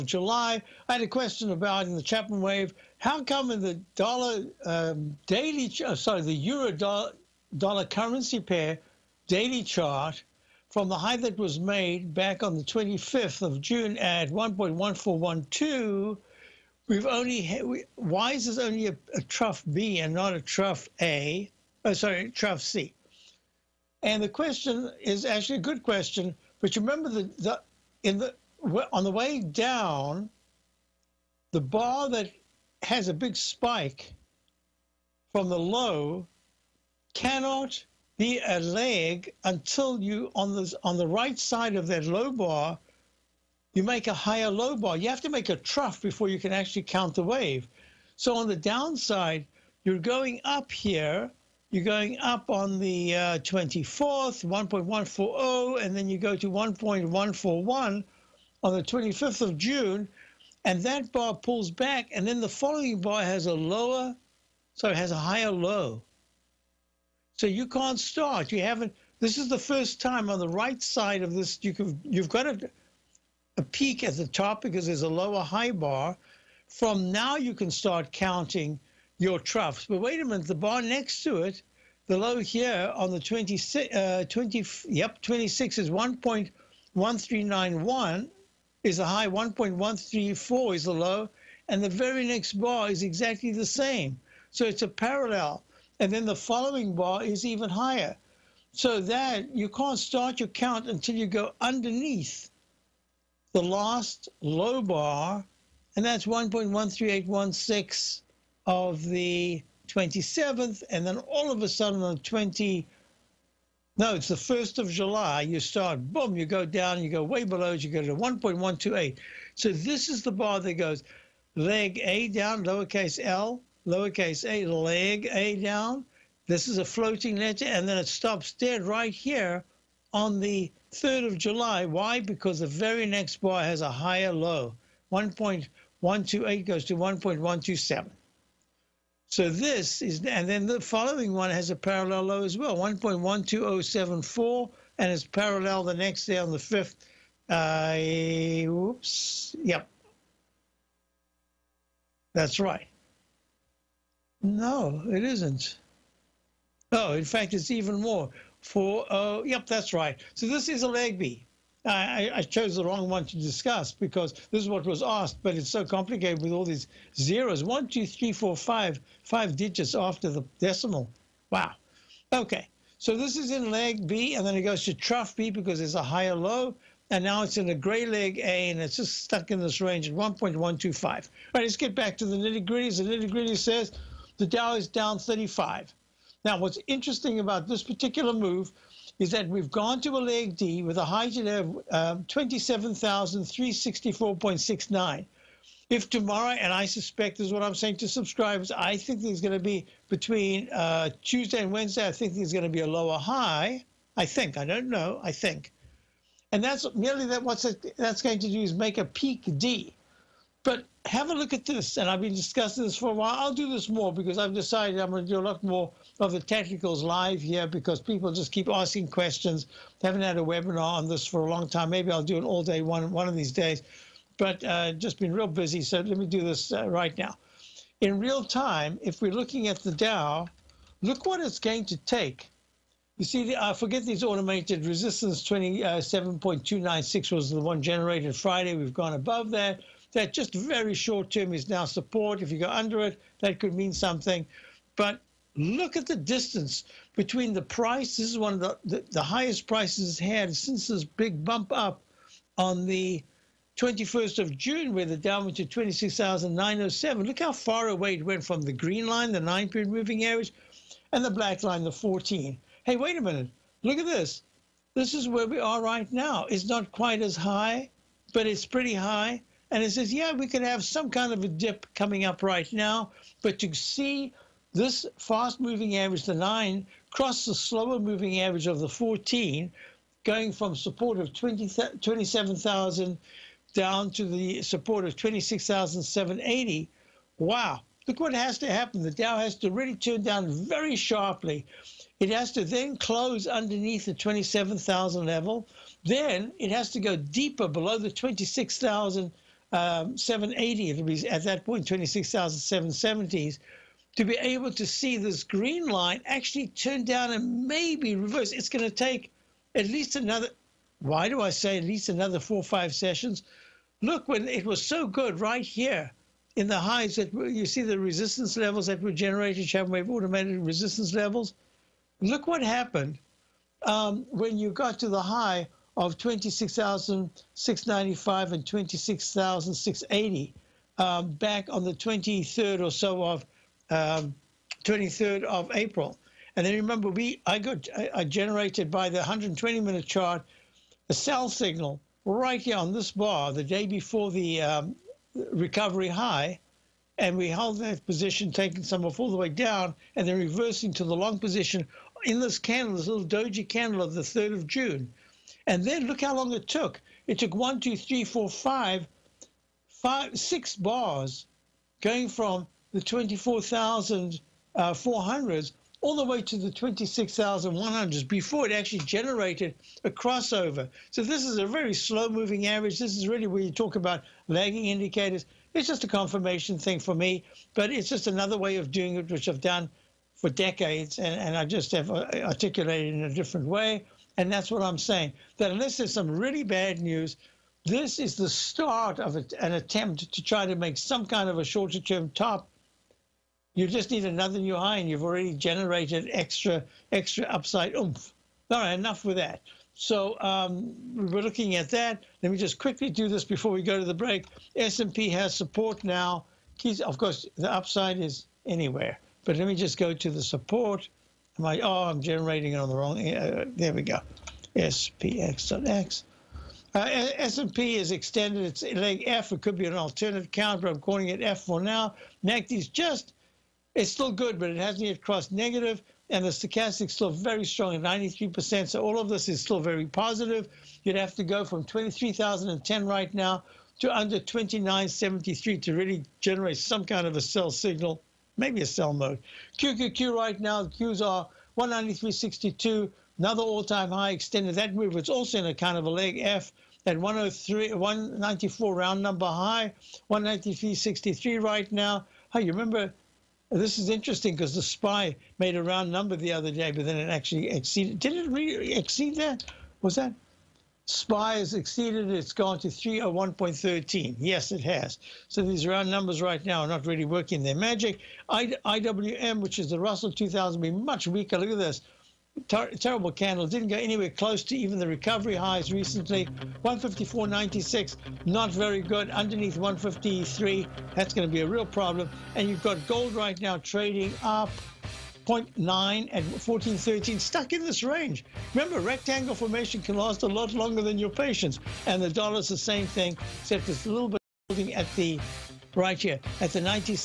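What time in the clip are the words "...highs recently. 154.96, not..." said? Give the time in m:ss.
7:55.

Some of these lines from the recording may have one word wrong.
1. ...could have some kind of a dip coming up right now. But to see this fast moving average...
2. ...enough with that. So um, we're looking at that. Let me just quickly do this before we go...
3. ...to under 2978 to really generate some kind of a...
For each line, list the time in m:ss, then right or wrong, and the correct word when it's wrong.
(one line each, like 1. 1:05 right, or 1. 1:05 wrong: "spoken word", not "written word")
1. 4:30 right
2. 6:38 right
3. 7:13 wrong: "2973", not "2978".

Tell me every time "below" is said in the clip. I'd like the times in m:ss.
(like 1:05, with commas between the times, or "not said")
1:57, 4:57.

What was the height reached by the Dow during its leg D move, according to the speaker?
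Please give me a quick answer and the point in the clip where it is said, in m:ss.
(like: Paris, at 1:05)
27,364.69, at 3:12.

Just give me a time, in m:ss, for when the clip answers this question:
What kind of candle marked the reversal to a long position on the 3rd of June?
5:53.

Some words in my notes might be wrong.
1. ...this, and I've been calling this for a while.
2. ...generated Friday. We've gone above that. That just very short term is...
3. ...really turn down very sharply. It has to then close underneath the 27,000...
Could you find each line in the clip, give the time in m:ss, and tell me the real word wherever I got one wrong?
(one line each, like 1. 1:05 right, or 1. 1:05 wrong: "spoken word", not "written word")
1. 3:31 wrong: "discussing", not "calling"
2. 3:57 right
3. 4:49 right.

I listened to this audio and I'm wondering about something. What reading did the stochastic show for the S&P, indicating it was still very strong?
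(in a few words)
93%.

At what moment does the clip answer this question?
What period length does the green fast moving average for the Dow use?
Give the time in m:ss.
4:19.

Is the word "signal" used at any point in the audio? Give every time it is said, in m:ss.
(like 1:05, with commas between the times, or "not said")
5:41, 7:17.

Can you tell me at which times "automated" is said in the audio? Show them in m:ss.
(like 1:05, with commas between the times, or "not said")
3:54, 5:20.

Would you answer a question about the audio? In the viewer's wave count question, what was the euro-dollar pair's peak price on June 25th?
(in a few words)
1.1412.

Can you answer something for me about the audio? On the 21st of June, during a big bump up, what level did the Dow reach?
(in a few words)
26,907.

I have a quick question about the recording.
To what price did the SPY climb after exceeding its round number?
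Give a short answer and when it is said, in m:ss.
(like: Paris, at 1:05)
301.13, at 7:42.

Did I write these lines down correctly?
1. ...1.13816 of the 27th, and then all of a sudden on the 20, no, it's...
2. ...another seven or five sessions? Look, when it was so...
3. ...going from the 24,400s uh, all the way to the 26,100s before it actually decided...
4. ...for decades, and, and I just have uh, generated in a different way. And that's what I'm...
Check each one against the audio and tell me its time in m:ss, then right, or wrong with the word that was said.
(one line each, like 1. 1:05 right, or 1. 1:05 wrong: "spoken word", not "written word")
1. 1:46 right
2. 5:12 wrong: "four", not "seven"
3. 6:02 wrong: "generated", not "decided"
4. 6:20 wrong: "articulated", not "generated".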